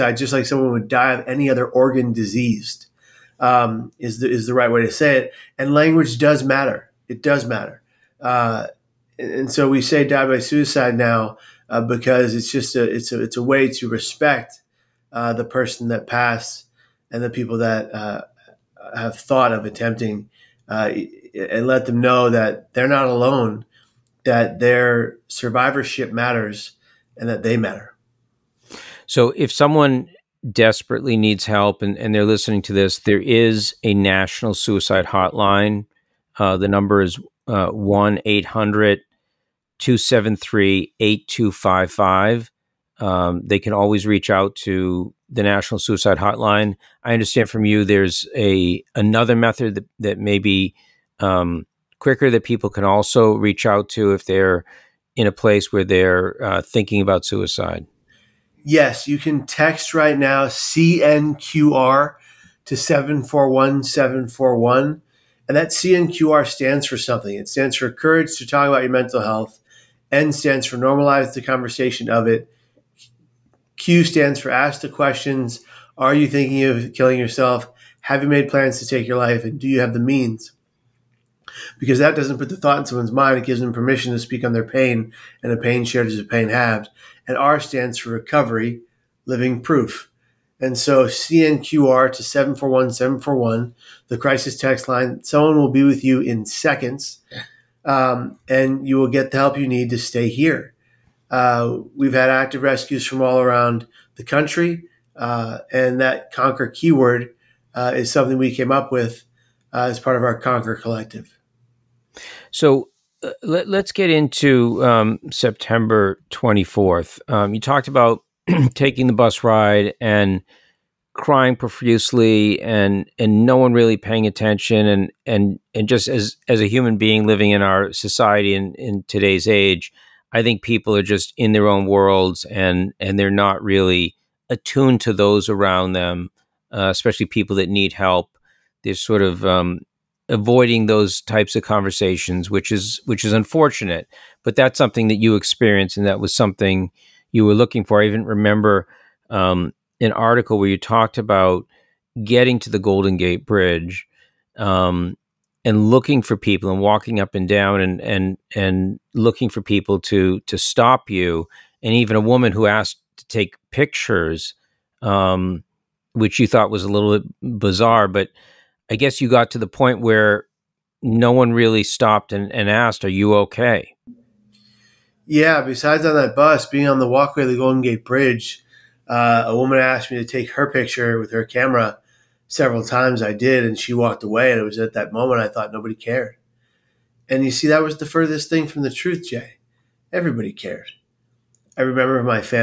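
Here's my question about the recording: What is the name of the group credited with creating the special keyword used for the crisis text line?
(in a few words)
Conquer Collective.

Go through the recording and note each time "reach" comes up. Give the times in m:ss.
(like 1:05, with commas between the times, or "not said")
0:44, 0:53.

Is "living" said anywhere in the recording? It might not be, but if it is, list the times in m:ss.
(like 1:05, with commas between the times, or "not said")
1:29, 2:07.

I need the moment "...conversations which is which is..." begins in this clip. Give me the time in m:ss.
2:21.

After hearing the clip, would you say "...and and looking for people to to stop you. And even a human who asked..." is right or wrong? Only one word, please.
wrong.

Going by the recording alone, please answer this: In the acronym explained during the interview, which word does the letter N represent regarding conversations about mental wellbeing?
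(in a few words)
Normalize.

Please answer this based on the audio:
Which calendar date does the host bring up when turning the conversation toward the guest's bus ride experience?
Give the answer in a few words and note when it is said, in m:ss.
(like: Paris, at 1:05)
September 24, at 1:55.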